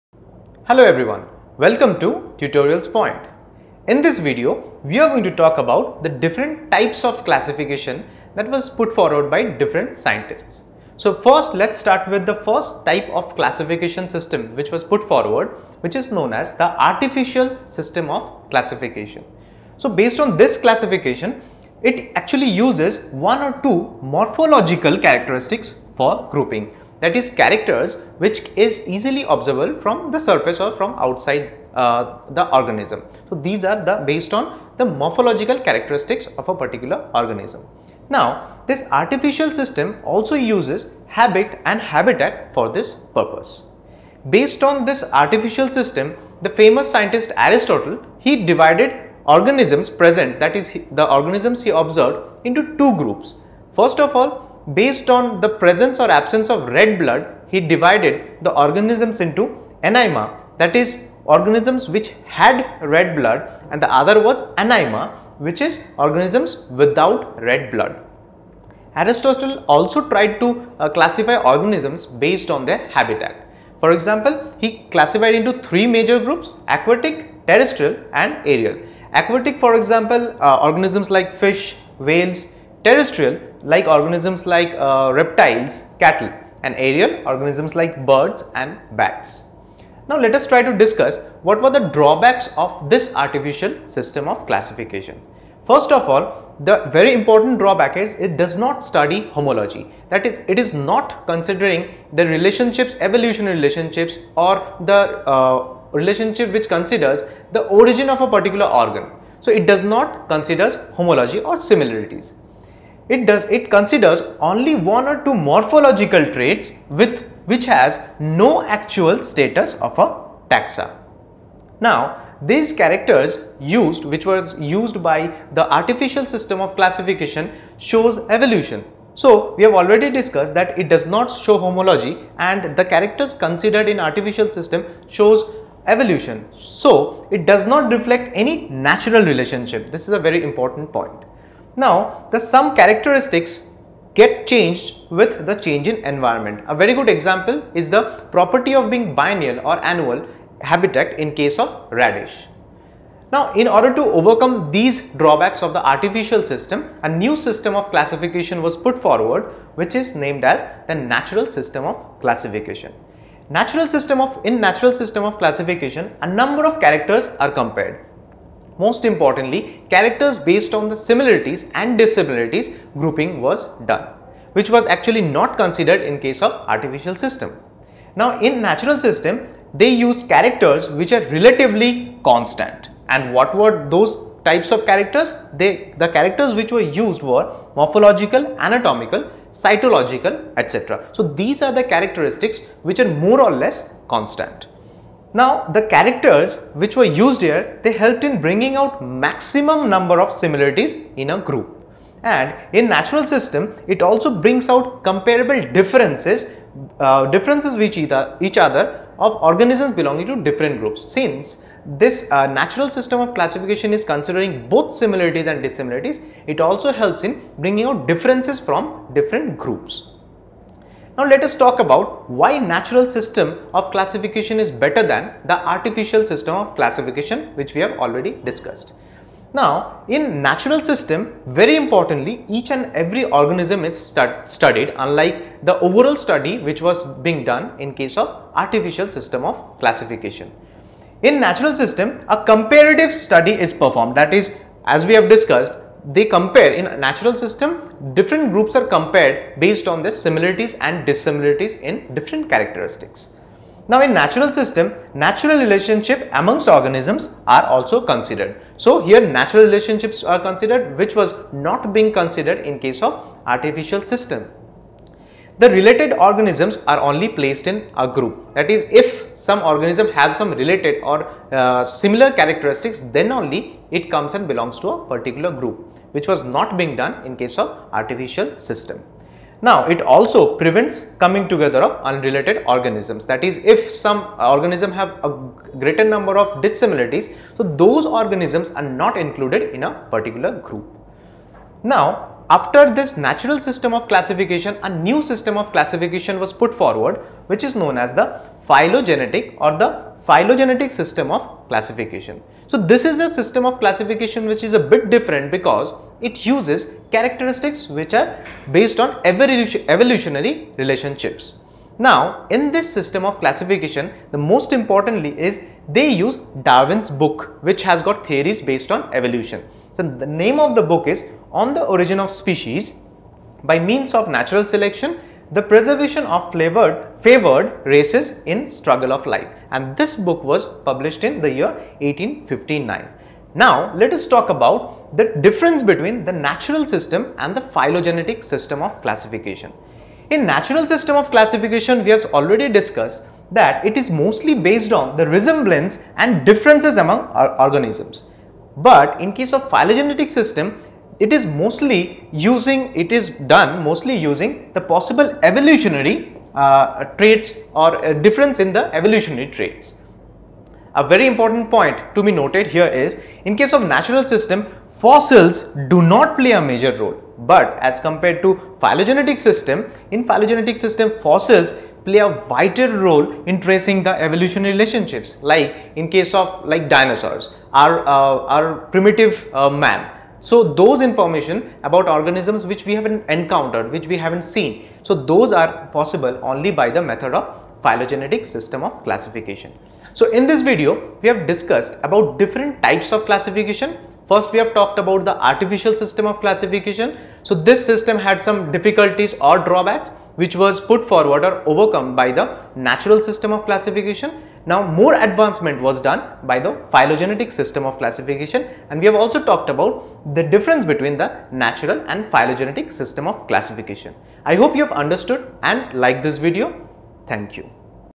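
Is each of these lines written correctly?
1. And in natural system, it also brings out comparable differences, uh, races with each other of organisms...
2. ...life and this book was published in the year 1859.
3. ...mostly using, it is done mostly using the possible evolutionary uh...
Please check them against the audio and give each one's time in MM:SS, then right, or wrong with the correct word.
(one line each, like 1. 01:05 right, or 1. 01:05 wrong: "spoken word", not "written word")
1. 03:22 wrong: "differences", not "races"
2. 05:29 right
3. 05:51 right.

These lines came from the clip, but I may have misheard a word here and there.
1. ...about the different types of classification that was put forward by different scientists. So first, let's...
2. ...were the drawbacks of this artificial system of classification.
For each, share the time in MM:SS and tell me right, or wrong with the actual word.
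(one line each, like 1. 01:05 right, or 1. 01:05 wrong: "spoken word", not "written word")
1. 00:05 right
2. 01:31 right.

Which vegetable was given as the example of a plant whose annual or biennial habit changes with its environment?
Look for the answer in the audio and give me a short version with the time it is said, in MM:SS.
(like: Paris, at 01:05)
Radish, at 02:31.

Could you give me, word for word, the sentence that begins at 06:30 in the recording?
So in this video, we have discussed about different types of classification First, we have talked about the artificial system of classification.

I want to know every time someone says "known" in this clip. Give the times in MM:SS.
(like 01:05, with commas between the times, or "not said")
00:16, 04:57.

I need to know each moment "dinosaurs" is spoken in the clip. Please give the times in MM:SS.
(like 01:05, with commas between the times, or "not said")
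06:16.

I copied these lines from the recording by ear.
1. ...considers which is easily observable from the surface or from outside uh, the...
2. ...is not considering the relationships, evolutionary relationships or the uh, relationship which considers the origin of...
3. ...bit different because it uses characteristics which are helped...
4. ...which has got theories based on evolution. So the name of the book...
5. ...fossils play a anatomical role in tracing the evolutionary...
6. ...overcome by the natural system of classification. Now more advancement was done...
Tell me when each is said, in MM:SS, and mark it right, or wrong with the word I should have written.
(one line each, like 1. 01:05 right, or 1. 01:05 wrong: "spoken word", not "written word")
1. 00:27 wrong: "characters", not "considers"
2. 01:40 right
3. 05:04 wrong: "based", not "helped"
4. 05:17 right
5. 06:11 wrong: "vital", not "anatomical"
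6. 06:41 right.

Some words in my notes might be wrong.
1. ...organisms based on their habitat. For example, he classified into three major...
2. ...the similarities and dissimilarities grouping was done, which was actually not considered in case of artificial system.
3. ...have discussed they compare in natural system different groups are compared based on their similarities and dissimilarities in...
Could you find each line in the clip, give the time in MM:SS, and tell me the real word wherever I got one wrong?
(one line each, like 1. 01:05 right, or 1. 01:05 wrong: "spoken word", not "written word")
1. 01:11 right
2. 02:50 right
3. 04:05 right.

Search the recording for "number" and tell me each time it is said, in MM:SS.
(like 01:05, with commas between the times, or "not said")
02:46, 03:19, 04:46.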